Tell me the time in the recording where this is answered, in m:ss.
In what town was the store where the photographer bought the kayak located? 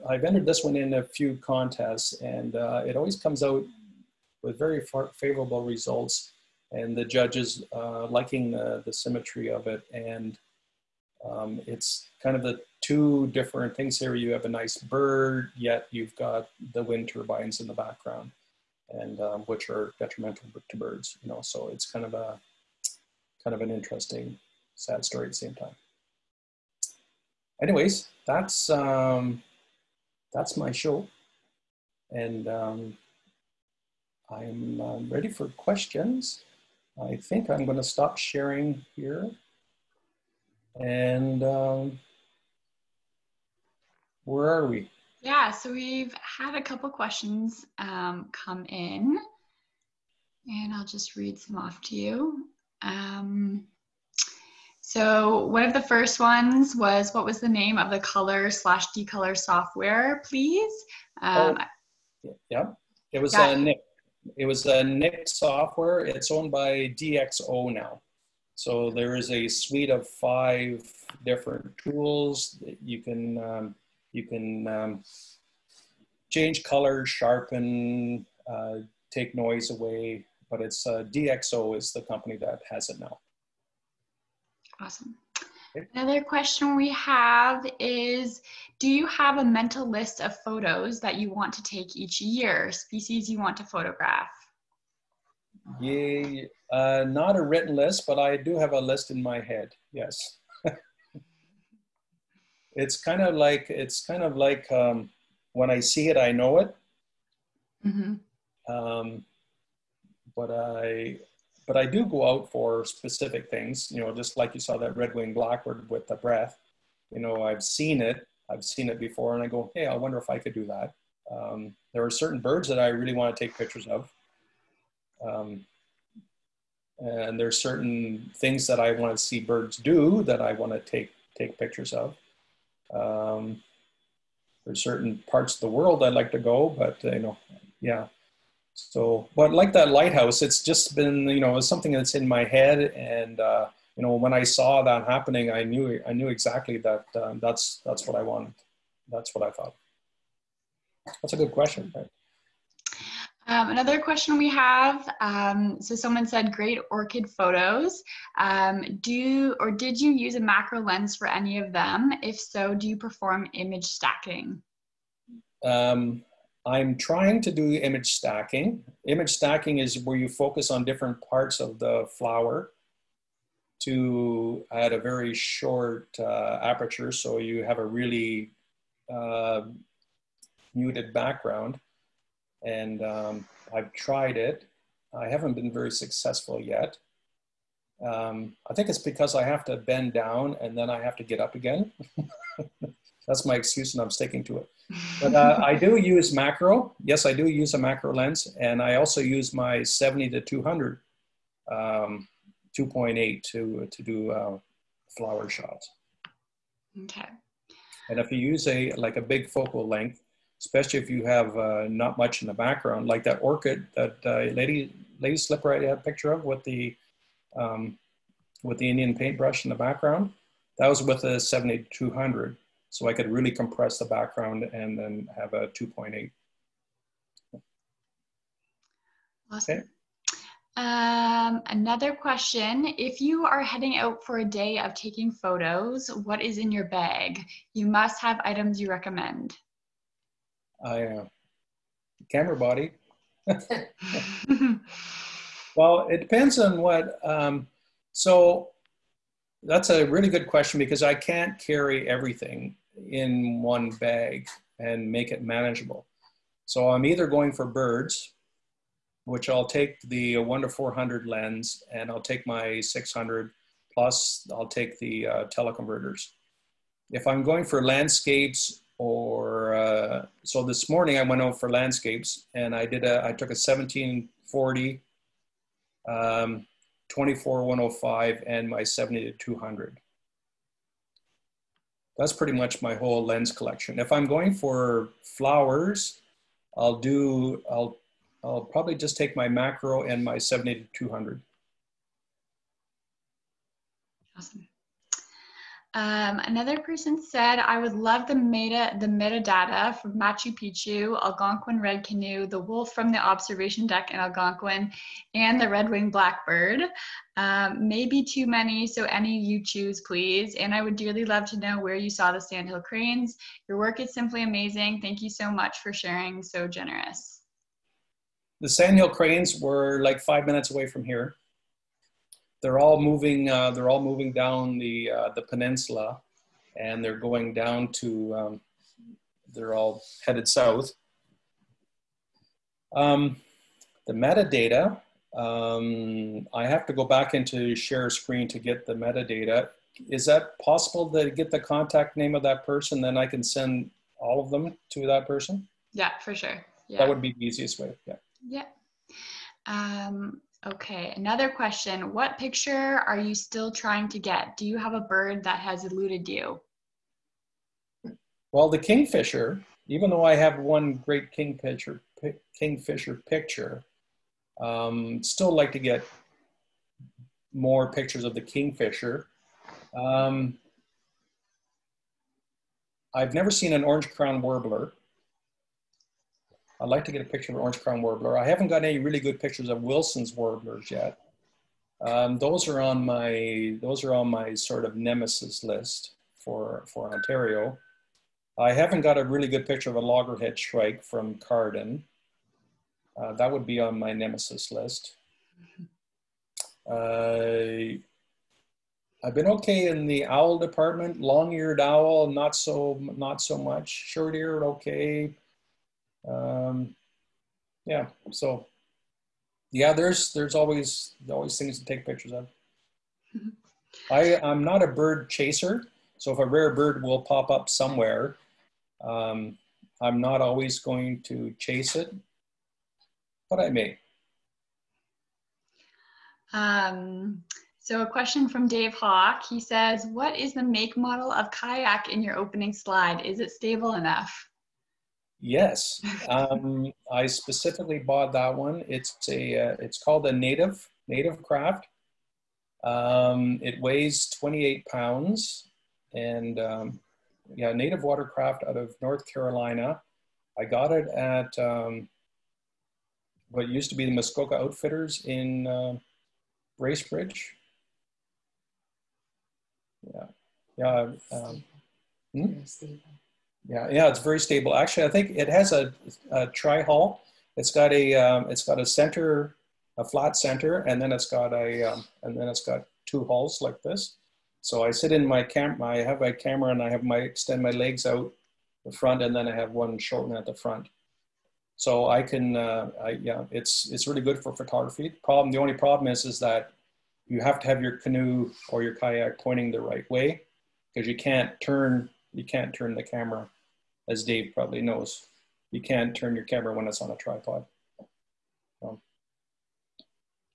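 7:36.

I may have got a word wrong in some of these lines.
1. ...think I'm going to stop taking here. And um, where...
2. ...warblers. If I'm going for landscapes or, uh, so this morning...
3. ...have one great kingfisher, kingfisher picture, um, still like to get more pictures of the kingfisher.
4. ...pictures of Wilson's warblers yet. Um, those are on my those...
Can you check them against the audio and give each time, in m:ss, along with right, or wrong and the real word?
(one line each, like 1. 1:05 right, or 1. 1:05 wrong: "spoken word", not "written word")
1. 0:37 wrong: "sharing", not "taking"
2. 4:25 wrong: "teleconverters", not "warblers"
3. 6:00 right
4. 6:19 right.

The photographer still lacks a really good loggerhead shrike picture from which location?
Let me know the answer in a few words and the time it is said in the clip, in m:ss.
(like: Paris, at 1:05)
Carden, at 6:31.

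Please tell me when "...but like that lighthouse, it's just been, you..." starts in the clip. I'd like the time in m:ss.
2:19.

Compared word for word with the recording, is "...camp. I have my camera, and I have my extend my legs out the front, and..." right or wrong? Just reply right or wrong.
right.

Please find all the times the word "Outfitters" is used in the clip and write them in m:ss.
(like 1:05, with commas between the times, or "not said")
7:34.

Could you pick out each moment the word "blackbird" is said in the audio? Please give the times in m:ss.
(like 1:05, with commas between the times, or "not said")
1:55, 5:06.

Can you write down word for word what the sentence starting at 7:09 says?
He says, "What is the make model of kayak in your opening slide?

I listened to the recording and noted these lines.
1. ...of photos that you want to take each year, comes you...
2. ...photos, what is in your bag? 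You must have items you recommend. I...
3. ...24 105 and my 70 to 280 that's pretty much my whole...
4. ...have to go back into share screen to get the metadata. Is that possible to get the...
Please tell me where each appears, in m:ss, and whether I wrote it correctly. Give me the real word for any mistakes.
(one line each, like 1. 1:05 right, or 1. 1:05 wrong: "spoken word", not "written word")
1. 1:30 wrong: "species", not "comes"
2. 3:55 right
3. 4:37 wrong: "200", not "280"
4. 5:36 right.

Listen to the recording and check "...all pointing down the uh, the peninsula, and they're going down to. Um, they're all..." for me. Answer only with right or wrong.
wrong.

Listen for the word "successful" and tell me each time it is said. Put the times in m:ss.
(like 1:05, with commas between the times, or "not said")
3:05.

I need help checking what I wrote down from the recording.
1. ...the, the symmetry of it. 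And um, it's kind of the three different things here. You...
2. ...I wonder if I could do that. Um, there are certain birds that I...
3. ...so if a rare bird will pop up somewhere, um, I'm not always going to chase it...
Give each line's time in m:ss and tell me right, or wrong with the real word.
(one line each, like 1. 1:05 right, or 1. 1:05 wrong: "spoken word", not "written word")
1. 0:08 wrong: "two", not "three"
2. 1:59 right
3. 6:56 right.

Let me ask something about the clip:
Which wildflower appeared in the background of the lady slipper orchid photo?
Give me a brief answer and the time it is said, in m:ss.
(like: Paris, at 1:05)
Indian paintbrush, at 3:38.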